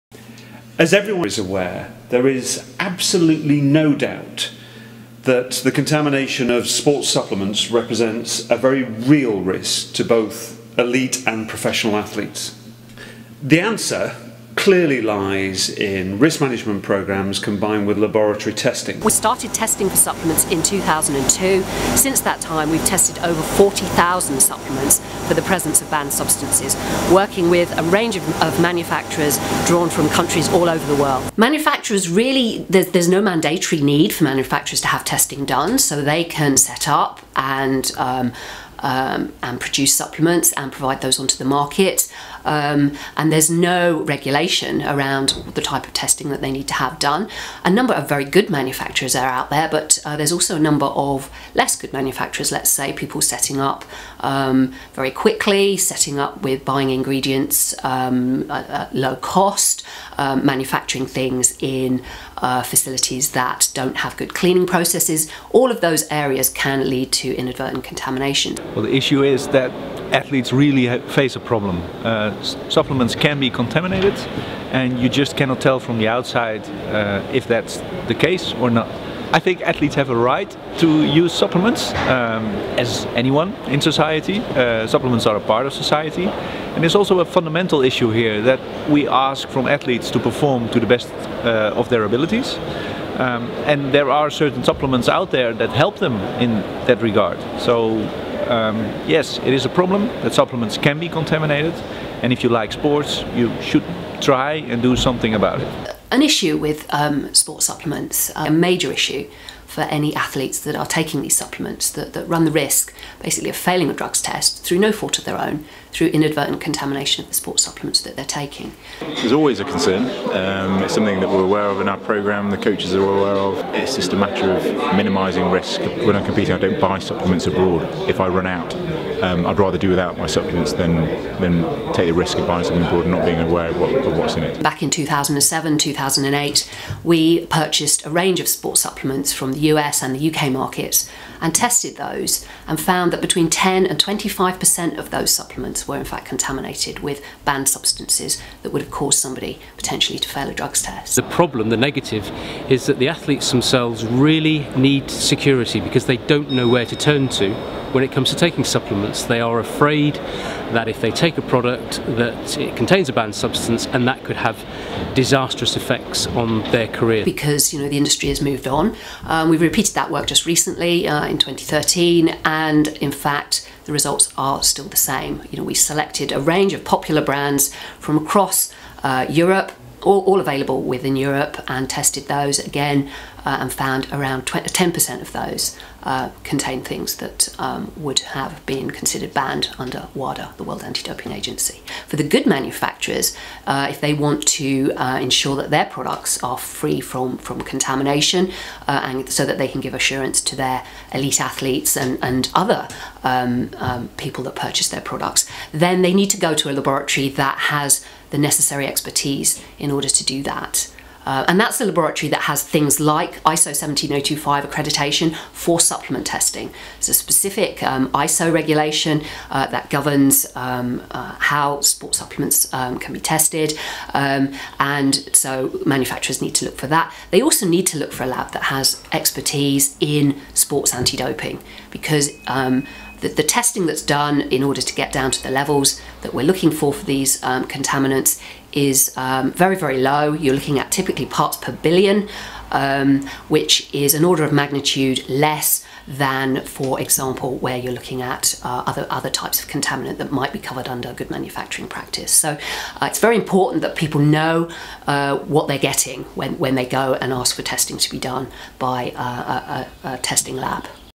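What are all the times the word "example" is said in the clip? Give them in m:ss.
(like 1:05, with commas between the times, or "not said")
4:06.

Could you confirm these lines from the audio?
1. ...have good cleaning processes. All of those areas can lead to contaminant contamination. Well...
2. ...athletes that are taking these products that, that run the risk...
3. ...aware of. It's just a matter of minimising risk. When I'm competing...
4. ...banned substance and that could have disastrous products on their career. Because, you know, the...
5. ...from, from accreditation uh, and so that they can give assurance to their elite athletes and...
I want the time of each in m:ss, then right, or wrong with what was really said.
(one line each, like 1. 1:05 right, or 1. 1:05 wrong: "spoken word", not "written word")
1. 1:03 wrong: "inadvertent", not "contaminant"
2. 1:50 wrong: "supplements", not "products"
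3. 2:03 right
4. 2:43 wrong: "effects", not "products"
5. 3:17 wrong: "contamination", not "accreditation".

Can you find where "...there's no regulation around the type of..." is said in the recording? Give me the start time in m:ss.
0:43.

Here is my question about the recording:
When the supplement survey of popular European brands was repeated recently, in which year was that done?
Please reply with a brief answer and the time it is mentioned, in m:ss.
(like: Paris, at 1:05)
2013, at 2:51.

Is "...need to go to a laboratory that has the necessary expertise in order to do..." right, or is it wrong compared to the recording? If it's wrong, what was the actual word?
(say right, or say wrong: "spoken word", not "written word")
right.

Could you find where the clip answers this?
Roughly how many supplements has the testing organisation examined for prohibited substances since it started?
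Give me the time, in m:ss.
0:23.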